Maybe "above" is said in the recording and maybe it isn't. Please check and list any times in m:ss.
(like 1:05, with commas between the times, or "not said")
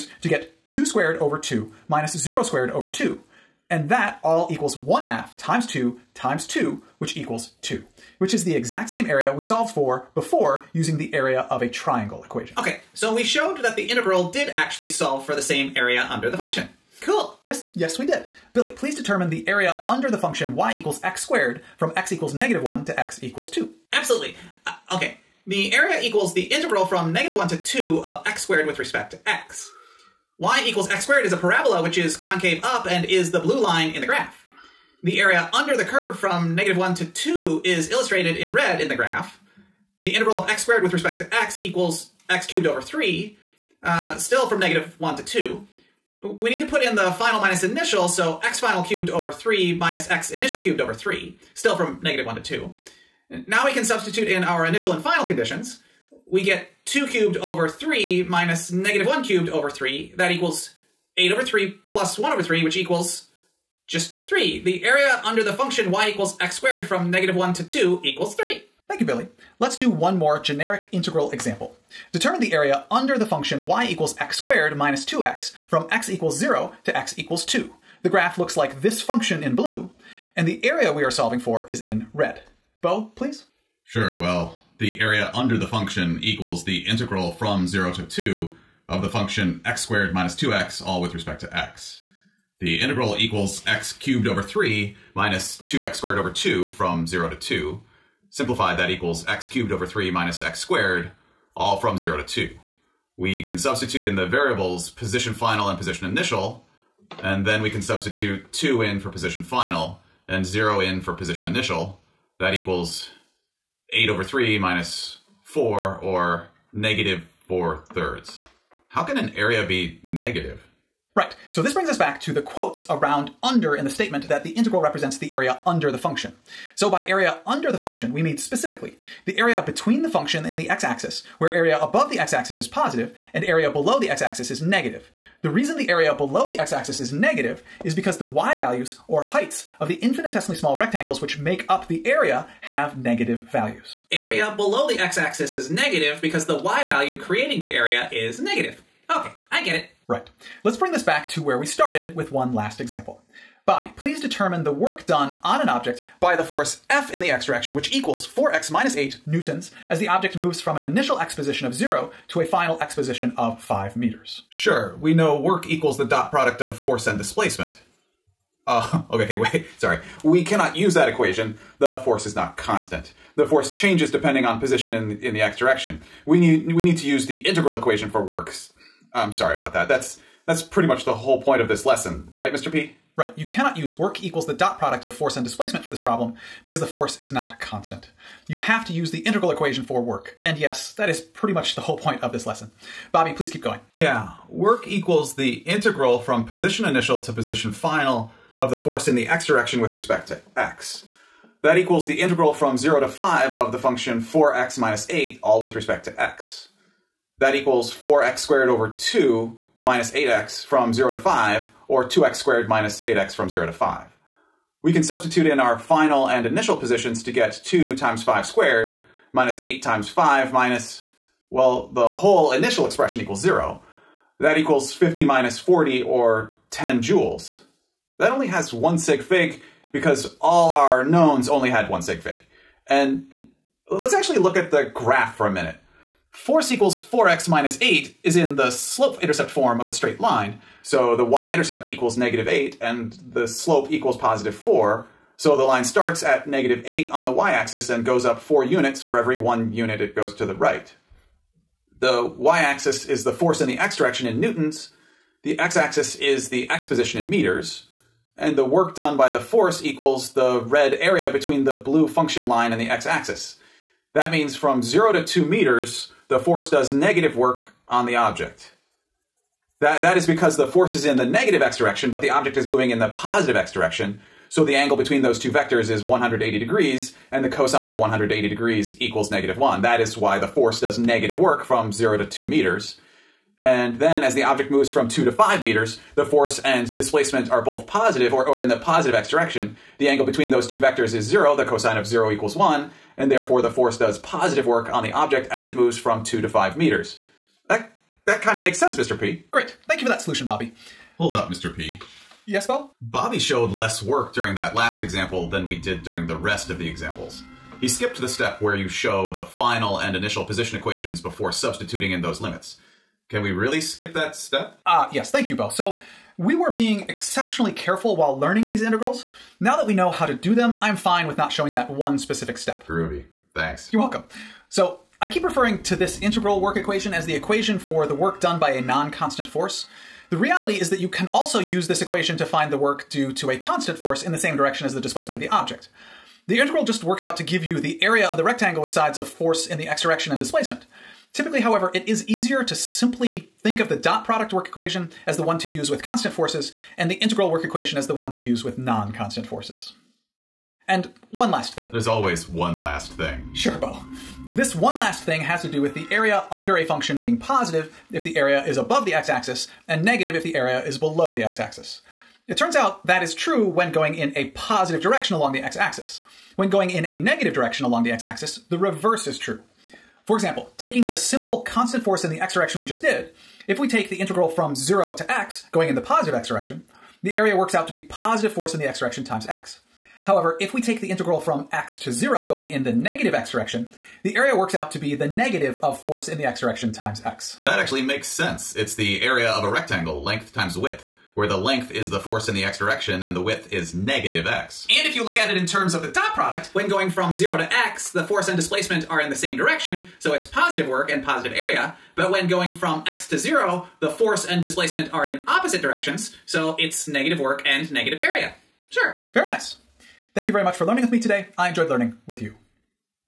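2:11, 5:58.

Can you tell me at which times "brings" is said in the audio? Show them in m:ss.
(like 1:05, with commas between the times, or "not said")
2:01, 2:30.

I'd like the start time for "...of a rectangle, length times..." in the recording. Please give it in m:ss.
6:29.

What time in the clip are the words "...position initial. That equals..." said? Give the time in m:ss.
1:51.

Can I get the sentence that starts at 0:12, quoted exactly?
Okay, so we showed that the integral did actually solve for the same area under the function.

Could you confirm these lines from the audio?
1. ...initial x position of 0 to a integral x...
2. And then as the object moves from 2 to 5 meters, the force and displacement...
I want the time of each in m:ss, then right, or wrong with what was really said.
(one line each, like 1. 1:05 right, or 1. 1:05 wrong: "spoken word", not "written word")
1. 2:40 wrong: "final", not "integral"
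2. 4:43 right.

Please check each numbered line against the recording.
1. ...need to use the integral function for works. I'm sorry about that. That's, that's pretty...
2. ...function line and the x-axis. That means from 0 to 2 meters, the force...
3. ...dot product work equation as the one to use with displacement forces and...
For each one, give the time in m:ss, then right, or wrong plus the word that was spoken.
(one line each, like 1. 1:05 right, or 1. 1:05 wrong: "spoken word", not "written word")
1. 2:56 wrong: "equation", not "function"
2. 4:22 right
3. 5:43 wrong: "constant", not "displacement".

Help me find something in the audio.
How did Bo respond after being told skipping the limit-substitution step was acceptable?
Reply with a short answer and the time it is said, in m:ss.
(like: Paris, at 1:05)
Groovy, at 5:22.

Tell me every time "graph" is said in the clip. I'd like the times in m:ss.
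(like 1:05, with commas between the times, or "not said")
0:34, 0:38, 1:18, 3:54.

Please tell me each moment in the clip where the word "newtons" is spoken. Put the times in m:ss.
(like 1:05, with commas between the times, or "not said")
2:39, 4:14.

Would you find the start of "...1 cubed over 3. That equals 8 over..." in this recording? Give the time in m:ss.
0:59.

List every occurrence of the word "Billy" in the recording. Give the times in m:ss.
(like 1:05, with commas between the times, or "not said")
0:18, 1:09.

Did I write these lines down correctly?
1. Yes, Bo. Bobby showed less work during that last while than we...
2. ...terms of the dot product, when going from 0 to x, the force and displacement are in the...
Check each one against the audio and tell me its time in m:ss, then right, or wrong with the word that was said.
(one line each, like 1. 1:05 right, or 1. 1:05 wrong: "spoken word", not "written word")
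1. 5:02 wrong: "example", not "while"
2. 6:35 right.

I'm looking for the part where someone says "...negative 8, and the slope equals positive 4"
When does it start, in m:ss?
4:02.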